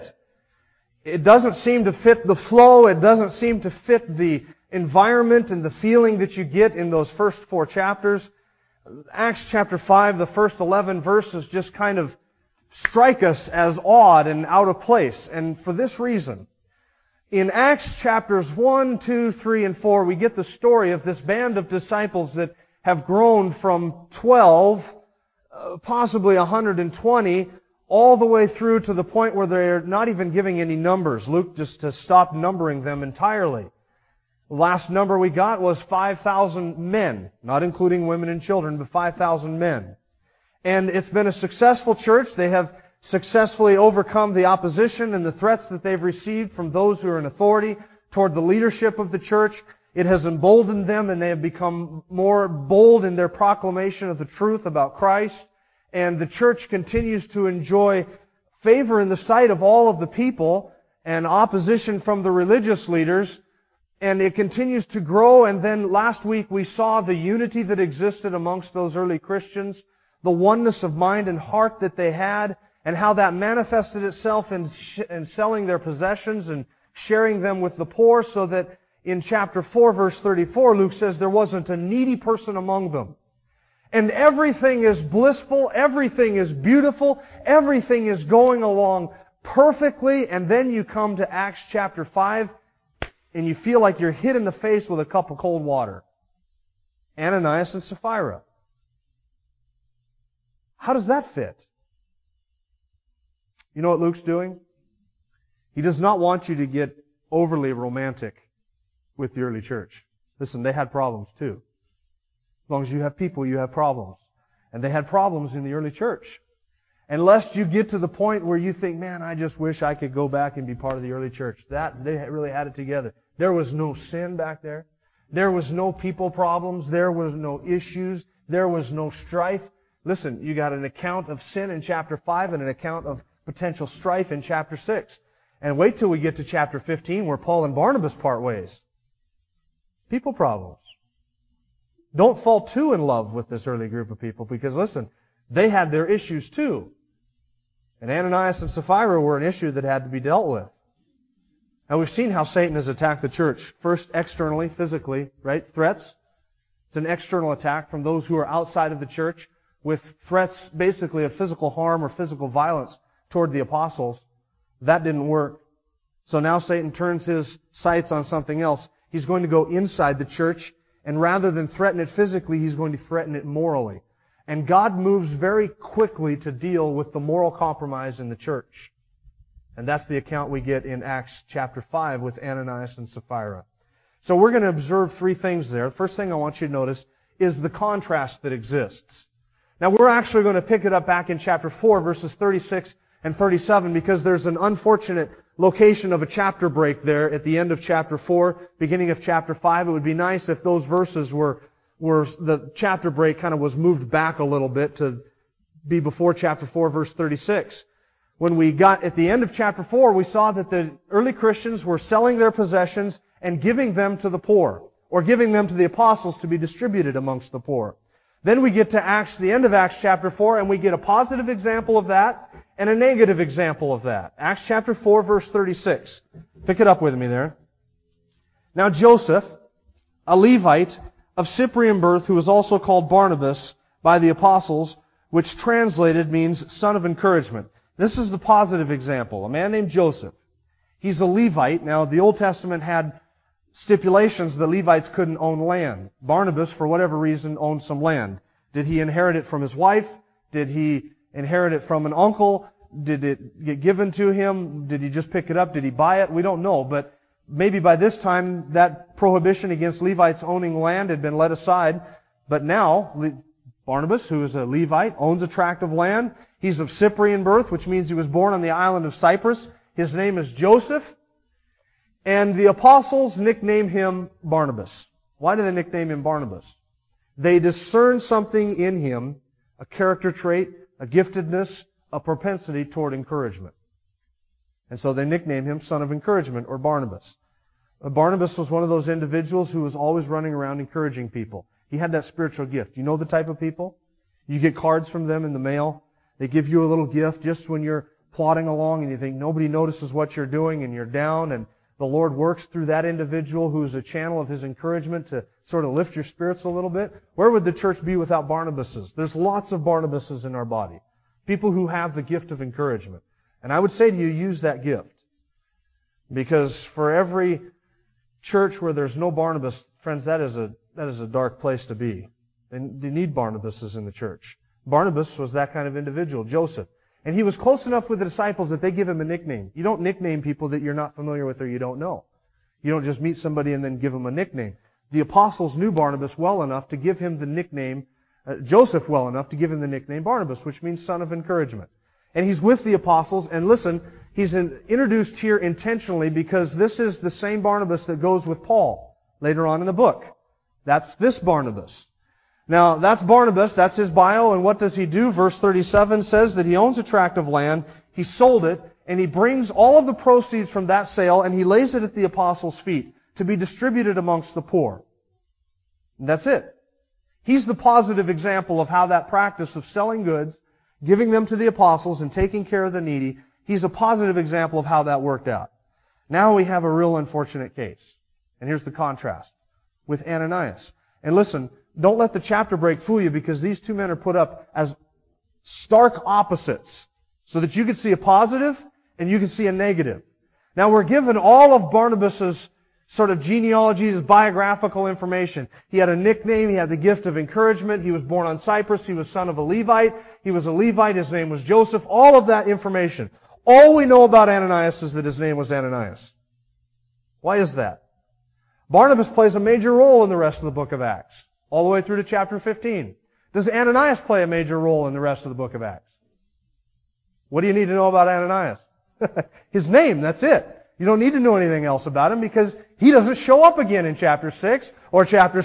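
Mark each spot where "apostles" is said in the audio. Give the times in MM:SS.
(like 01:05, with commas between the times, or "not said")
02:43, 03:35, 03:54, 04:32, 05:35, 05:42, 06:02, 06:11.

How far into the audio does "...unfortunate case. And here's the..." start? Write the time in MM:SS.
06:17.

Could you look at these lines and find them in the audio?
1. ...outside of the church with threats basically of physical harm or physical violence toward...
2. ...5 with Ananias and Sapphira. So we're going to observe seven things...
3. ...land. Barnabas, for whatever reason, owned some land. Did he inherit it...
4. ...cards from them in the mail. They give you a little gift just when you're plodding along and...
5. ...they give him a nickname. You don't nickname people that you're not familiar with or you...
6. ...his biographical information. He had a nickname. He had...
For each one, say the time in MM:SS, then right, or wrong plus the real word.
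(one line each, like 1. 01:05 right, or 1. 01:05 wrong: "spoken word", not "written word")
1. 02:38 right
2. 03:01 wrong: "three", not "seven"
3. 04:05 right
4. 04:54 right
5. 05:28 right
6. 06:34 right.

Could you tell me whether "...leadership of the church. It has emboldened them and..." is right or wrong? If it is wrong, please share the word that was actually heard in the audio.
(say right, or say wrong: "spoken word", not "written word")
right.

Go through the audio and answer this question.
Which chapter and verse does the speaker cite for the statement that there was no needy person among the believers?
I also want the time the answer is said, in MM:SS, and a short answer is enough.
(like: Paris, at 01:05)
Chapter 4 verse 34, at 01:19.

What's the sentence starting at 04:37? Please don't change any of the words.
They discern something in him, a character trait, a giftedness, a propensity toward encouragement.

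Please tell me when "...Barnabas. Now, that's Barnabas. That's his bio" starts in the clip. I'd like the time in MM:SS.
05:51.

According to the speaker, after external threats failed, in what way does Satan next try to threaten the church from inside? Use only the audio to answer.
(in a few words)
Morally.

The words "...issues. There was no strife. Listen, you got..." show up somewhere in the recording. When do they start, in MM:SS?
02:07.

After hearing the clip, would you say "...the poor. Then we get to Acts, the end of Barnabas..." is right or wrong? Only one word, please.
wrong.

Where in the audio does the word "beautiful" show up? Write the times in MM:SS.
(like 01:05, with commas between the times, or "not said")
01:26.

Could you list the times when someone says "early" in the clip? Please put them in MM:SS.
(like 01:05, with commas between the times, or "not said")
01:08, 01:49, 01:55, 02:01, 02:23, 03:31.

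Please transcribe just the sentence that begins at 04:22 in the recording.
But now, Barnabas, who is a Levite, owns a tract of land.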